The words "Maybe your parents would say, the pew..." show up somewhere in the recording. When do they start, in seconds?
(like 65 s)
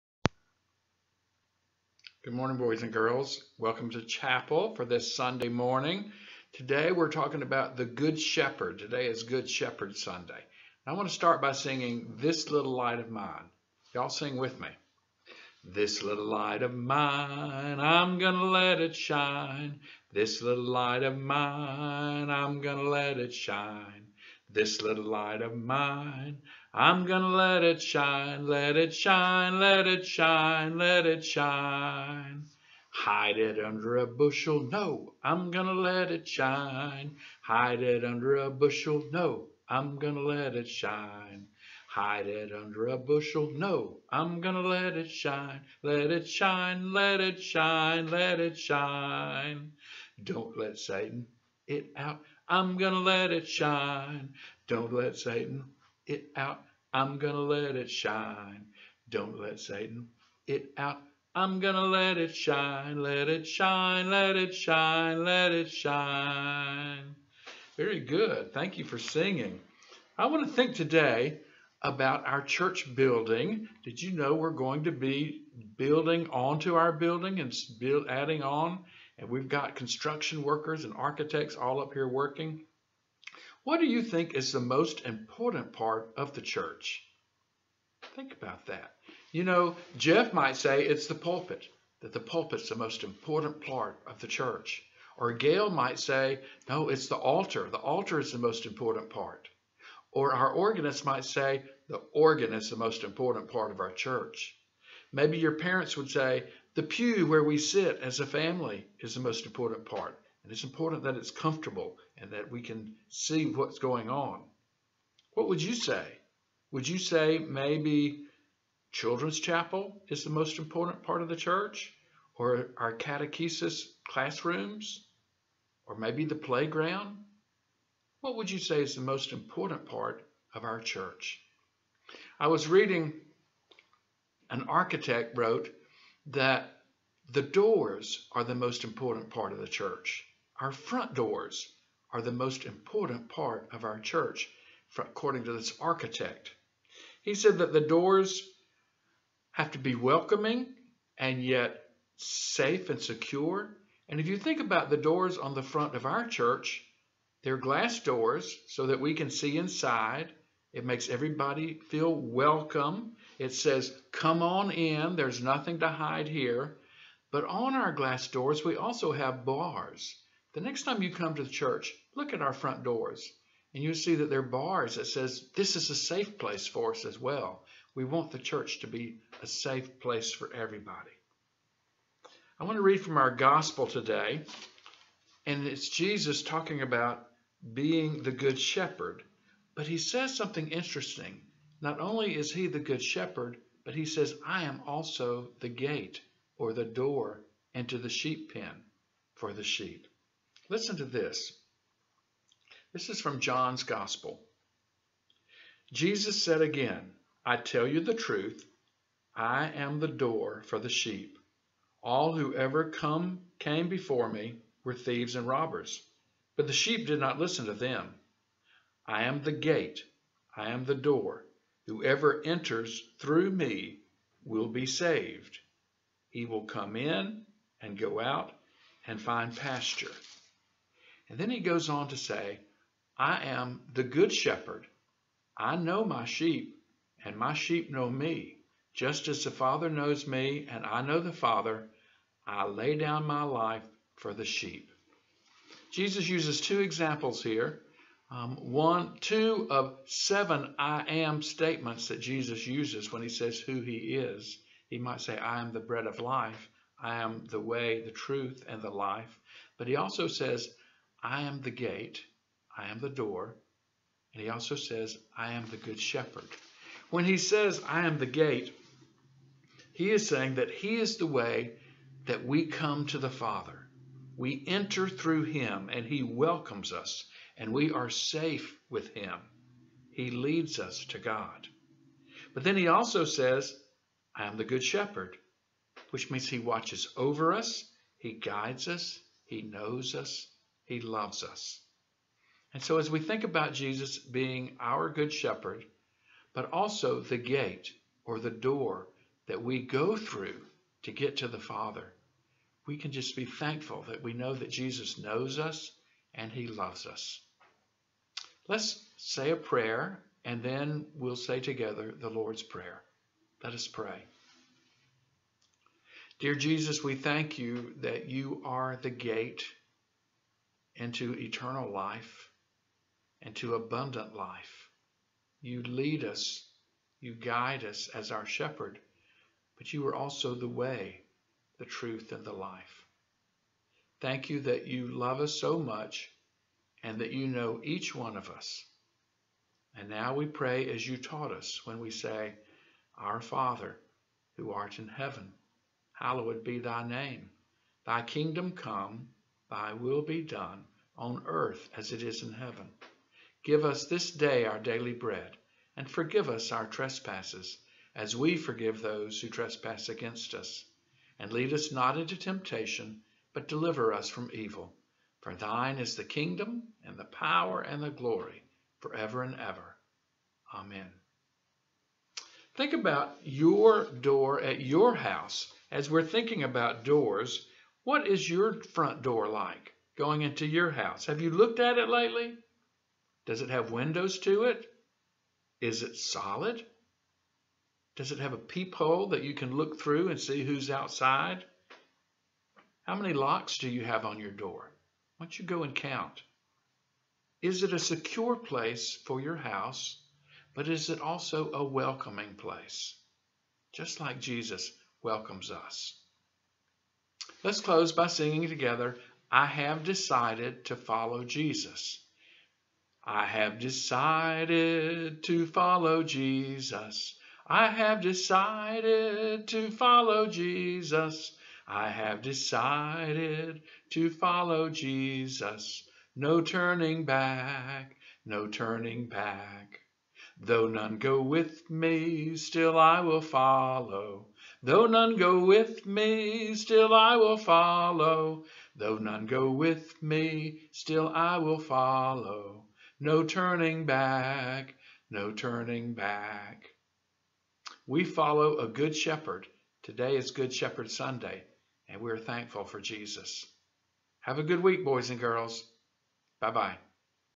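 105 s.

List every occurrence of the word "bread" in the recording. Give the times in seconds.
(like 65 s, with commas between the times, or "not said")
255 s, 355 s.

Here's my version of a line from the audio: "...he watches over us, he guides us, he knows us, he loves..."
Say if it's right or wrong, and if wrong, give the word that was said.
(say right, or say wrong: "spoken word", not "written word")
right.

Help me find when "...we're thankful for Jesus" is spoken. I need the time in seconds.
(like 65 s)
452 s.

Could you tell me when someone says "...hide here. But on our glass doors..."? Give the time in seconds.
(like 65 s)
165 s.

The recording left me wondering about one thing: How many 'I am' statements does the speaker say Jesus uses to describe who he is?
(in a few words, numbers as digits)
7.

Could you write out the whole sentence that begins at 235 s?
I know my sheep, and my sheep know me.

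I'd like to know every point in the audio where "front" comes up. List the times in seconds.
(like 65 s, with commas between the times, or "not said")
140 s, 155 s, 172 s, 378 s.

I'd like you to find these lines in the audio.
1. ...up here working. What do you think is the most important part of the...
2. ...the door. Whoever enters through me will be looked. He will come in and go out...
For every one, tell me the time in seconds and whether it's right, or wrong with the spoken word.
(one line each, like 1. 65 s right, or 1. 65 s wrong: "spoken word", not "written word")
1. 81 s right
2. 220 s wrong: "saved", not "looked".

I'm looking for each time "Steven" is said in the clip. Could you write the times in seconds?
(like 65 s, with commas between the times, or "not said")
not said.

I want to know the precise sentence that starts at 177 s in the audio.
We want the church to be a safe place for everybody.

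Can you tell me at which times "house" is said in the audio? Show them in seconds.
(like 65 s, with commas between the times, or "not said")
375 s, 380 s, 399 s.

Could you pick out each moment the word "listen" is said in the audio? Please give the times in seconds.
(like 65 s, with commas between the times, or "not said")
200 s, 217 s.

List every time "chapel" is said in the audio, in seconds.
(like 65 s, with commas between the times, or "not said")
4 s, 119 s.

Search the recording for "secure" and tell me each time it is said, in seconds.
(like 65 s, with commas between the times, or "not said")
153 s, 397 s.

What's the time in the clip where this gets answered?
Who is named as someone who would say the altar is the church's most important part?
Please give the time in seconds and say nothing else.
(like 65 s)
95 s.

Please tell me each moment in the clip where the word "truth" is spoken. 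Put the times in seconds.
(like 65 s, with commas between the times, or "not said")
208 s, 258 s, 331 s.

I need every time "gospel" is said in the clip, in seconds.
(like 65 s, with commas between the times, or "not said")
183 s, 203 s.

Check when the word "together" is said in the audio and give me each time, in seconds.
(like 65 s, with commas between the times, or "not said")
311 s, 408 s.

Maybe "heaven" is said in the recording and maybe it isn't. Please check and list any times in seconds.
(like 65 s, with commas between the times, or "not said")
345 s, 352 s.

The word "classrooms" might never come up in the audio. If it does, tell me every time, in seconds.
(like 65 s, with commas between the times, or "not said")
124 s.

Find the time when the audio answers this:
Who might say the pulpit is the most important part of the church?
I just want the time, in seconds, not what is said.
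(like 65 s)
89 s.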